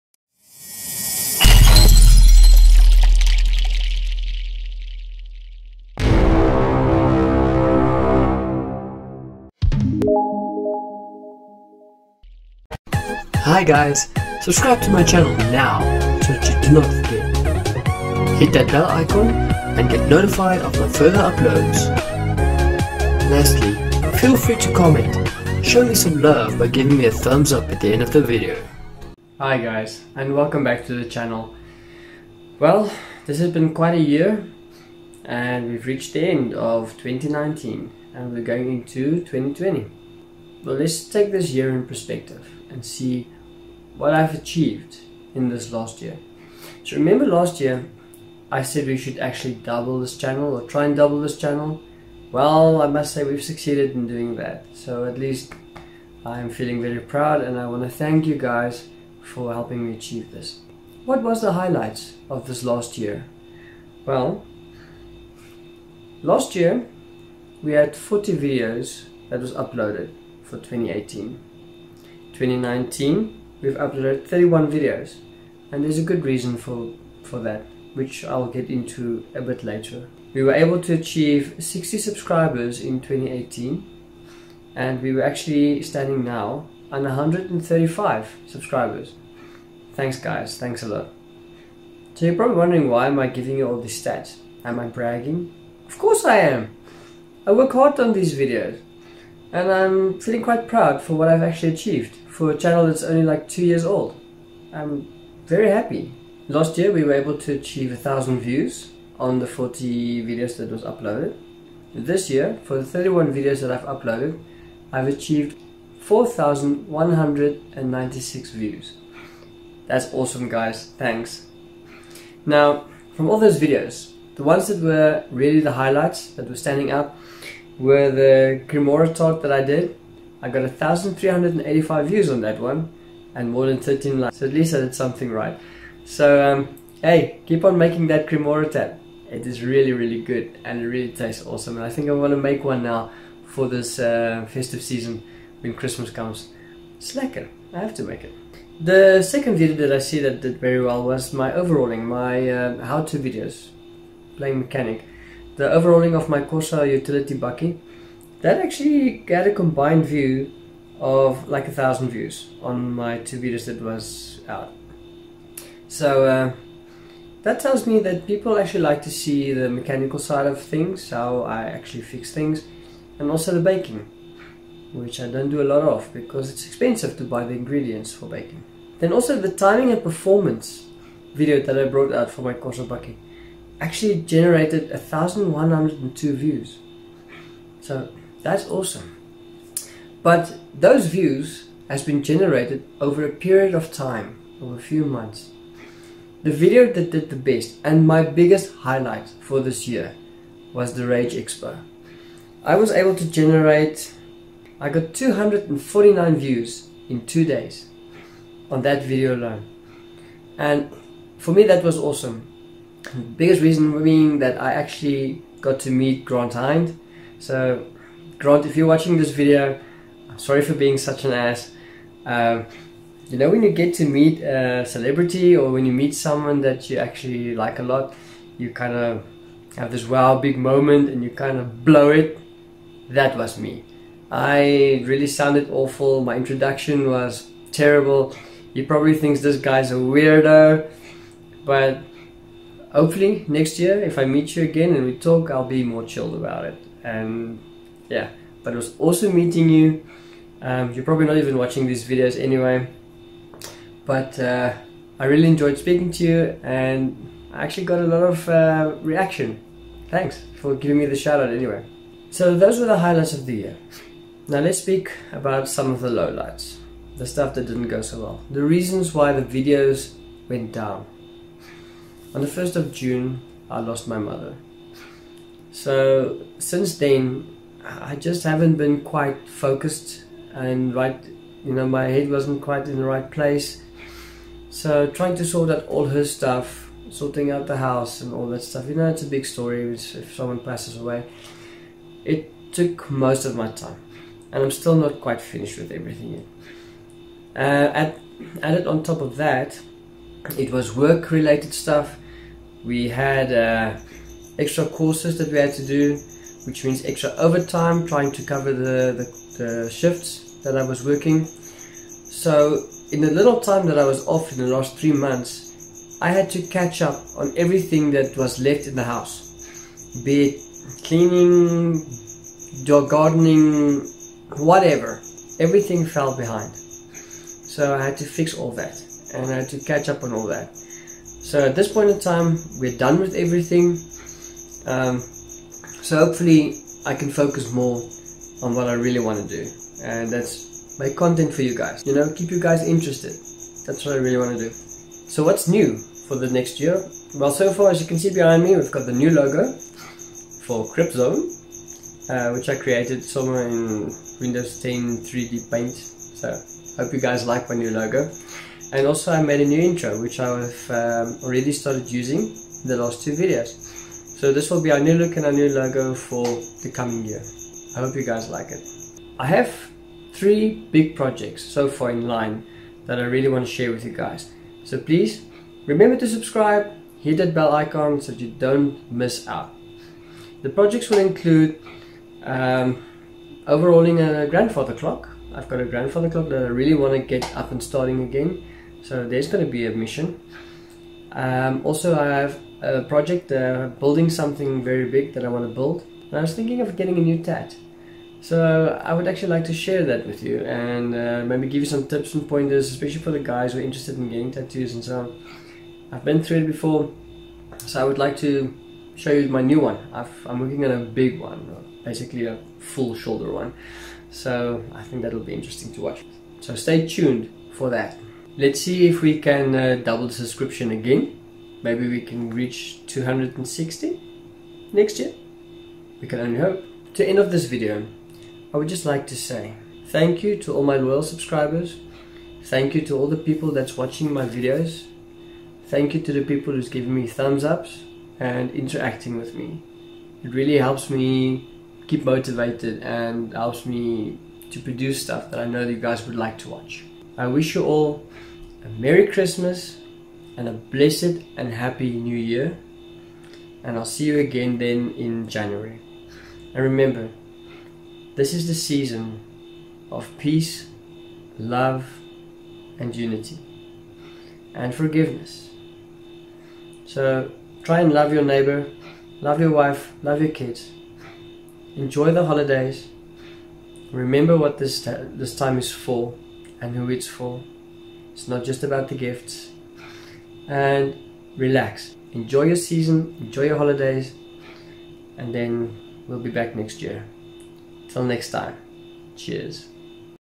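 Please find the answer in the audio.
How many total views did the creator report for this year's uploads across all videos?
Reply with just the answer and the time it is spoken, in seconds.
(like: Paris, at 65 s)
4,196, at 115 s.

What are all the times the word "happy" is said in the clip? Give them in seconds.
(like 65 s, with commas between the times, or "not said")
105 s, 451 s.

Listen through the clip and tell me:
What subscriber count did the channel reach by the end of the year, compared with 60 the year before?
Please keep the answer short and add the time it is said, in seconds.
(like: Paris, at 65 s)
135, at 87 s.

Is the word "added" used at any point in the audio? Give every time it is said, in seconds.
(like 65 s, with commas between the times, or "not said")
298 s.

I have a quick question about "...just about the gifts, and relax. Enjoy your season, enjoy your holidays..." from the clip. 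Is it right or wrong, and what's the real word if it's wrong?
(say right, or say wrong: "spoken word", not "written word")
right.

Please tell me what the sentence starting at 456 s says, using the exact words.
And remember, this is the season of peace, love, and unity, and forgiveness.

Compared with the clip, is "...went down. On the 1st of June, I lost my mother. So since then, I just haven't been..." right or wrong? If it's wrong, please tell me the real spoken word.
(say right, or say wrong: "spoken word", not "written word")
right.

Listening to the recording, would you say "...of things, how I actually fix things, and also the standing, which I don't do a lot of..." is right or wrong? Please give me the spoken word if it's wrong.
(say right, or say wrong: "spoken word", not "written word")
wrong: "baking", not "standing".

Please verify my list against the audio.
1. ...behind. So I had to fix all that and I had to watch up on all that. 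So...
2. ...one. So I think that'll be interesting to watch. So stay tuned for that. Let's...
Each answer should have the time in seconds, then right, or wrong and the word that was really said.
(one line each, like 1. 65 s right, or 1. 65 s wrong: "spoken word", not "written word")
1. 326 s wrong: "catch", not "watch"
2. 413 s right.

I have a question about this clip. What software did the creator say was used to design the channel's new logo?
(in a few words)
Windows 10 3D Paint.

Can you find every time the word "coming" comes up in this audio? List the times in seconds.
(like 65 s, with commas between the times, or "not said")
366 s.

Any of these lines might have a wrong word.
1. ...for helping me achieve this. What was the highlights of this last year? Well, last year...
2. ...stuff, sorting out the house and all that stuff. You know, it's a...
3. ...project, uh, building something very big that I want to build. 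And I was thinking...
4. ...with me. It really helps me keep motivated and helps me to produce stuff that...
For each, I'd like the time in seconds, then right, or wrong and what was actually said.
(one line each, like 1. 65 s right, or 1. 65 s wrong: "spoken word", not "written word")
1. 59 s right
2. 286 s right
3. 393 s right
4. 439 s right.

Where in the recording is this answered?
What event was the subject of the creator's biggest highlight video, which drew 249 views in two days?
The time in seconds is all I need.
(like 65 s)
201 s.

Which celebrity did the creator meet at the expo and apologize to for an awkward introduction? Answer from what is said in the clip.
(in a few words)
Grant Hind.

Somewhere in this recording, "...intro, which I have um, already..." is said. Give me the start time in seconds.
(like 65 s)
359 s.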